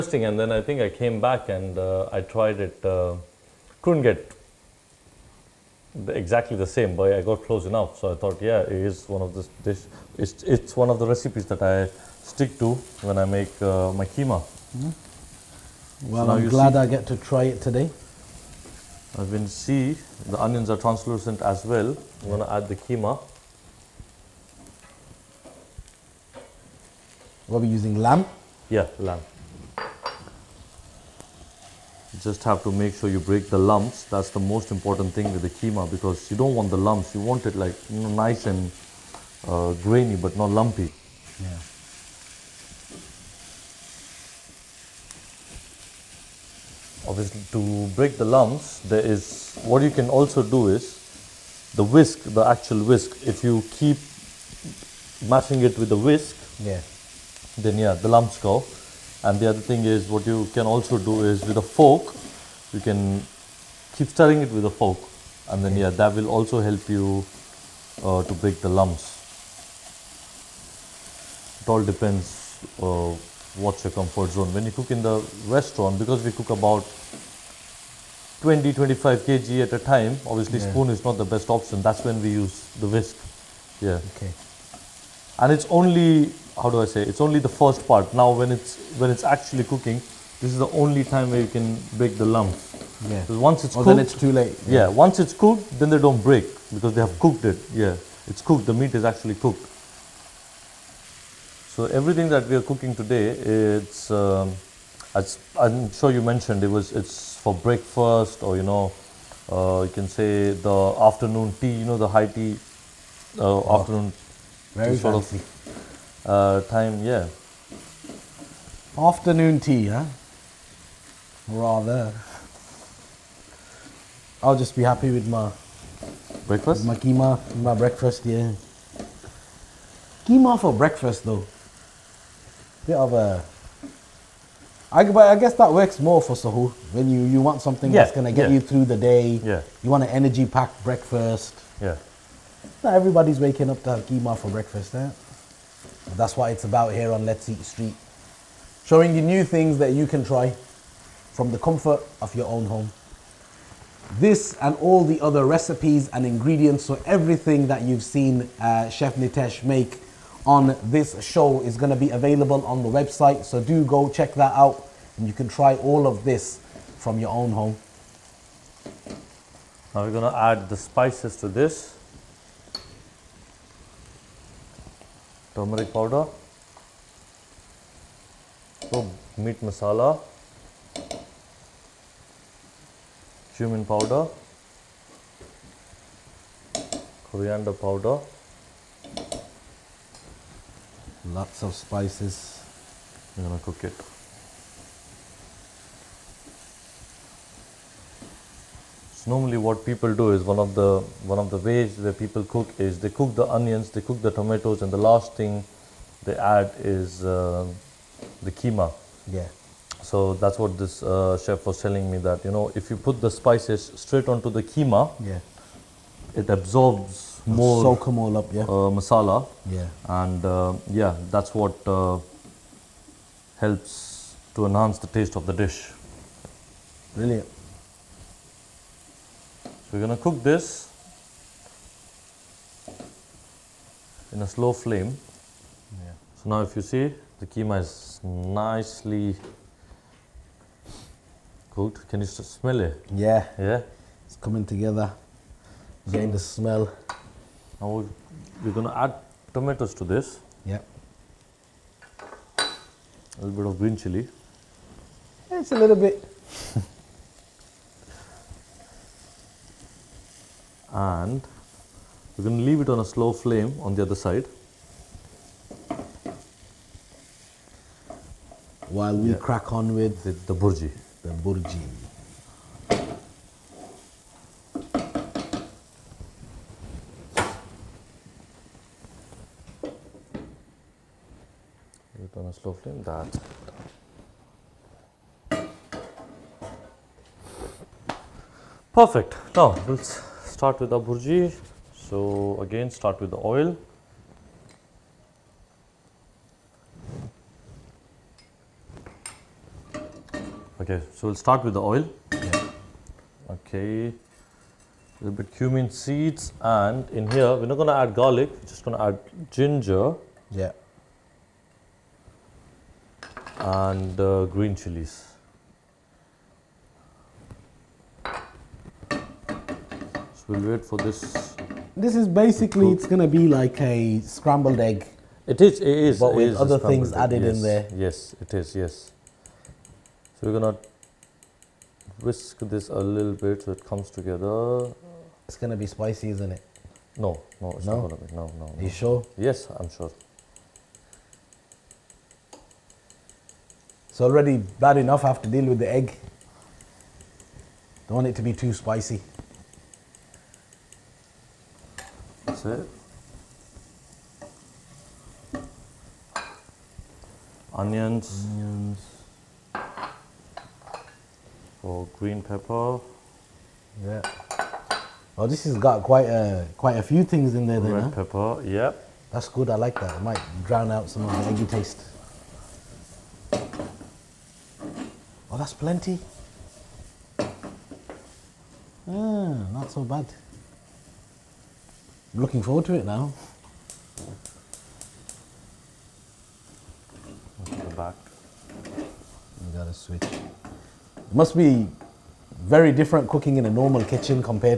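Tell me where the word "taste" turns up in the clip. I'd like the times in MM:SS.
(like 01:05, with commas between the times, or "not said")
03:45, 06:11.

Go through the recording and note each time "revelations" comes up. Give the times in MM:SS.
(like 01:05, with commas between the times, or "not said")
not said.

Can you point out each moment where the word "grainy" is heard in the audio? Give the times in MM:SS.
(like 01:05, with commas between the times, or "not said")
00:39.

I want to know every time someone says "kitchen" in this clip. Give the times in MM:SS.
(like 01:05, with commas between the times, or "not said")
06:34.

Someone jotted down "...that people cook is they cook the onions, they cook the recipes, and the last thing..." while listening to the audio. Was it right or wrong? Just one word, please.
wrong.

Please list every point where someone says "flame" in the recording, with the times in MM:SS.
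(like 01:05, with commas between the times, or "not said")
03:54, 04:23, 04:42.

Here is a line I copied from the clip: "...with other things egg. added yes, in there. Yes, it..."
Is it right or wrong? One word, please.
right.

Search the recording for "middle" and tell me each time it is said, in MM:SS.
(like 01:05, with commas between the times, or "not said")
not said.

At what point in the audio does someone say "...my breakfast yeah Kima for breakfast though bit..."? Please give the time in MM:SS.
02:07.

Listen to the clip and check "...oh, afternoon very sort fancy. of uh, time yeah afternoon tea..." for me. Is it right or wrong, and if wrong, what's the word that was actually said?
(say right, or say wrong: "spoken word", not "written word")
right.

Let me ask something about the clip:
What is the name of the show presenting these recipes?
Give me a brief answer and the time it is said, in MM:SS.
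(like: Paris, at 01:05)
Let's Eat Street, at 02:27.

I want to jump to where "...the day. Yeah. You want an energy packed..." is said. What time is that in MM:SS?
02:18.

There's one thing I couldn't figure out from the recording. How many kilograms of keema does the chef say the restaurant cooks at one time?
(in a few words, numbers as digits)
20-25 kg.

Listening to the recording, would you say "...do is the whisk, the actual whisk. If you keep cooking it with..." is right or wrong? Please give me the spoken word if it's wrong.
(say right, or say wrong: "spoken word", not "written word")
wrong: "mashing", not "cooking".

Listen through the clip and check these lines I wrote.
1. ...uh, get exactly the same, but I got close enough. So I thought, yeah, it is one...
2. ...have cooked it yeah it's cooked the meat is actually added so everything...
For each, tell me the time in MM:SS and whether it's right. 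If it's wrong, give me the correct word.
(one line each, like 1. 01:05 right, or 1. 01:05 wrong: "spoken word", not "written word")
1. 00:04 right
2. 01:37 wrong: "cooked", not "added".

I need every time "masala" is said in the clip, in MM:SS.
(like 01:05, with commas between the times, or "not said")
02:59, 03:38.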